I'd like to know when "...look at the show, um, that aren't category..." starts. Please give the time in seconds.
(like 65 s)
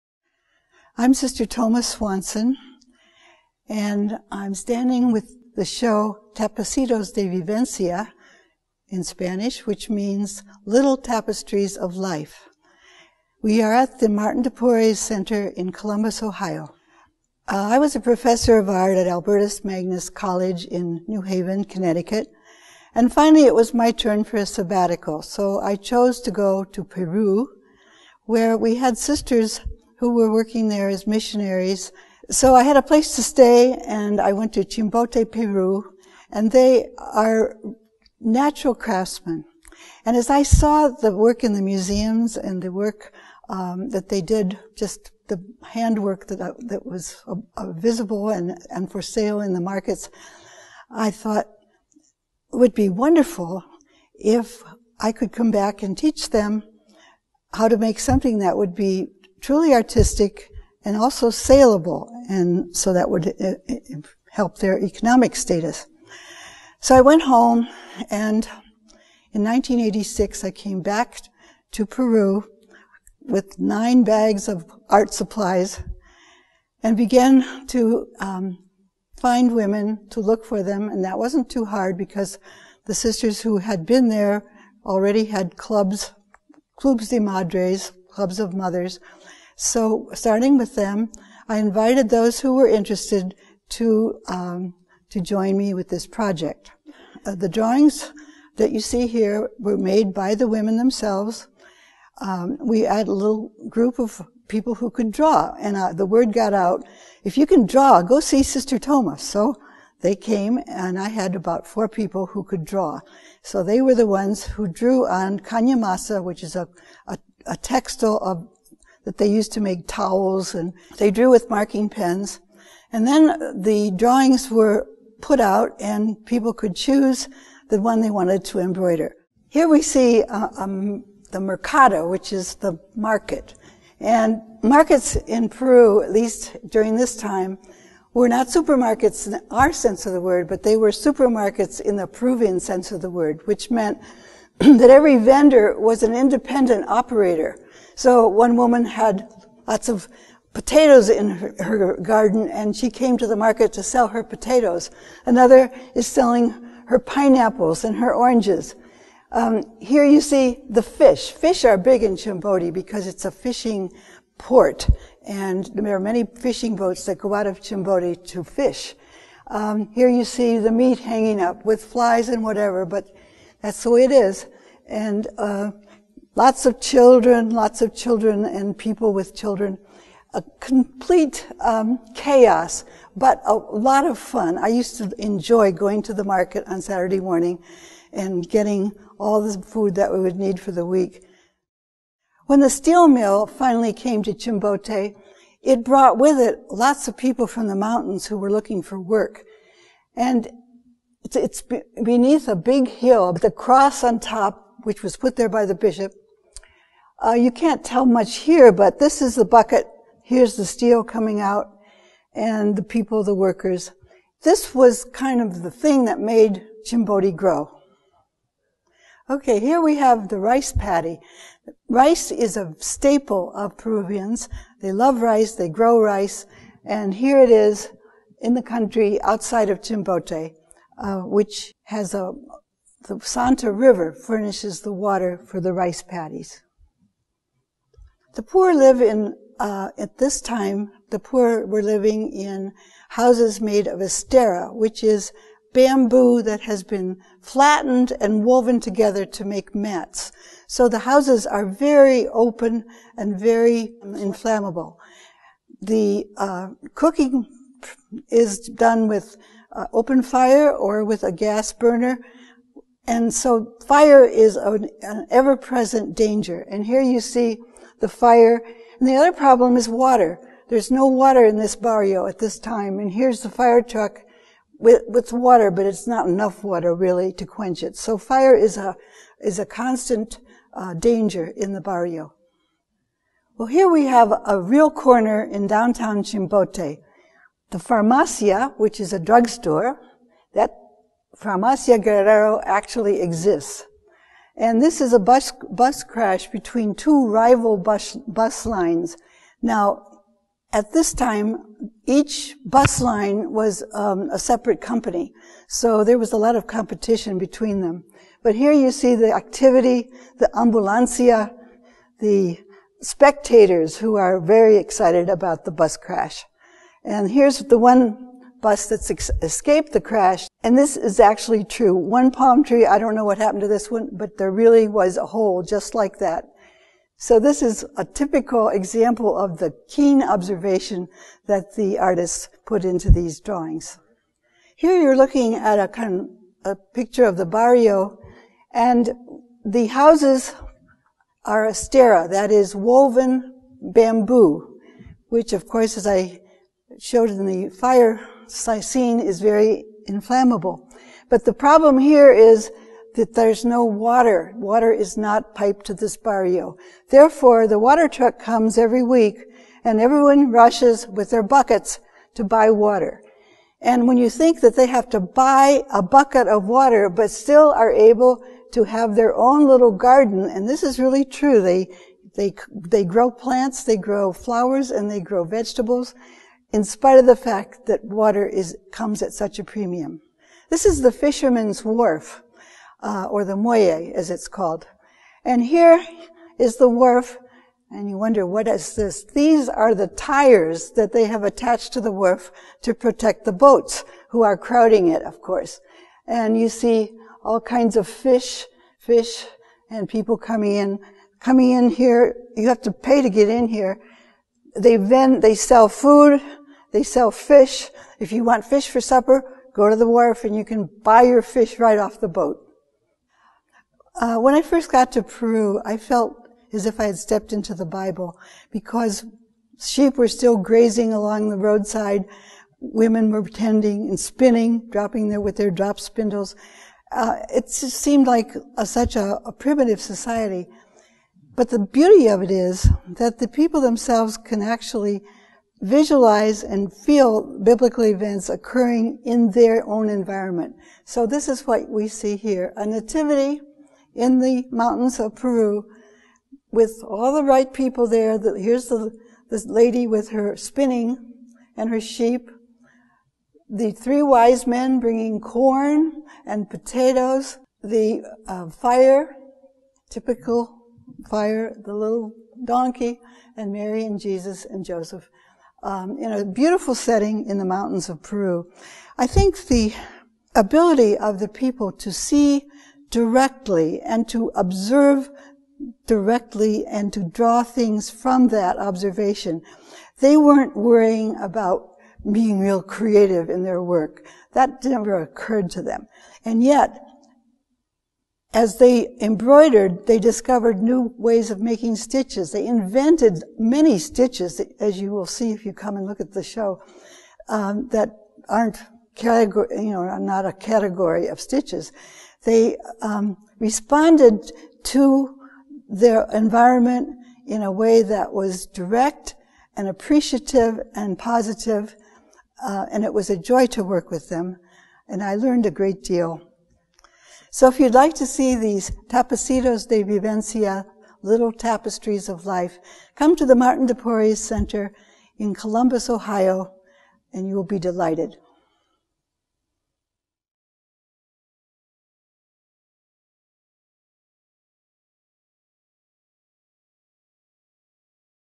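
496 s.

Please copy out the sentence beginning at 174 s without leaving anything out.
And uh, lots of children, lots of children and people with children.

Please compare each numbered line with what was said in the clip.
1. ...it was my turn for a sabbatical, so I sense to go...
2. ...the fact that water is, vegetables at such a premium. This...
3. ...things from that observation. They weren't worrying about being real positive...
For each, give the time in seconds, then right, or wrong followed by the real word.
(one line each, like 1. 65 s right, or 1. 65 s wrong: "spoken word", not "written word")
1. 23 s wrong: "chose", not "sense"
2. 377 s wrong: "comes", not "vegetables"
3. 477 s wrong: "creative", not "positive".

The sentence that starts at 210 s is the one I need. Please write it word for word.
Here's the steel coming out and the people, the workers.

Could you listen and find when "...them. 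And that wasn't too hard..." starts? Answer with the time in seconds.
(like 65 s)
80 s.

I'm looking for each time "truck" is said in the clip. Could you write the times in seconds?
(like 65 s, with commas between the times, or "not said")
273 s, 358 s.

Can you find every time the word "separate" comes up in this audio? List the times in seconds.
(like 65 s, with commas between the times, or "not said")
304 s.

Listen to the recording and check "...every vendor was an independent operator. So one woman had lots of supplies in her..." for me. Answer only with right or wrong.
wrong.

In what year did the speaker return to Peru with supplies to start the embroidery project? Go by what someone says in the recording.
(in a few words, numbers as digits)
1986.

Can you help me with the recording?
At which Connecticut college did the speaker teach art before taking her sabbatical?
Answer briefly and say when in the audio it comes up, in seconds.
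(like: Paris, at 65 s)
Albertus Magnus College, at 19 s.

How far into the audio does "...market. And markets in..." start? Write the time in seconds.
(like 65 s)
132 s.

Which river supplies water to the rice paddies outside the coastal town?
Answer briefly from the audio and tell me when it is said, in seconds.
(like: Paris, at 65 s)
Santa River, at 233 s.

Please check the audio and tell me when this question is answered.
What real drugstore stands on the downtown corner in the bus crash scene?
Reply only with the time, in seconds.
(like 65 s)
291 s.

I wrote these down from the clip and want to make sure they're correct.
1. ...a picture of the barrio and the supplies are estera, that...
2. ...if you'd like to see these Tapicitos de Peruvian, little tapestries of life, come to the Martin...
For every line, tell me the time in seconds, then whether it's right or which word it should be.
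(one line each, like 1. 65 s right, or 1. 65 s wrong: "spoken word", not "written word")
1. 336 s wrong: "houses", not "supplies"
2. 517 s wrong: "Vivencia", not "Peruvian".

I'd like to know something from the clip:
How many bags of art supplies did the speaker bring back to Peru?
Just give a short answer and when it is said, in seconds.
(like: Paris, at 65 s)
9, at 73 s.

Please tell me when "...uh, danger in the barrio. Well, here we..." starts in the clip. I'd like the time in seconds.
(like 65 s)
280 s.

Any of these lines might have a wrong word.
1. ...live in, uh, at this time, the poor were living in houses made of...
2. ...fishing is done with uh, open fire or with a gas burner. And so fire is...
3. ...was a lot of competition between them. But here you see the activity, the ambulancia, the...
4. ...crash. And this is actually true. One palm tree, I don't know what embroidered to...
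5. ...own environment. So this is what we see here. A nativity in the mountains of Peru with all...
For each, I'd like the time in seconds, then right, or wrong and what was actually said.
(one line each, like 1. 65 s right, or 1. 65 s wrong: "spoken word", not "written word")
1. 238 s right
2. 256 s wrong: "cooking", not "fishing"
3. 306 s right
4. 320 s wrong: "happened", not "embroidered"
5. 439 s right.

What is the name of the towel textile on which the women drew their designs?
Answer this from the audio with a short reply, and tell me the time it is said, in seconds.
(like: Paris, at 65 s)
kanyamasa, at 115 s.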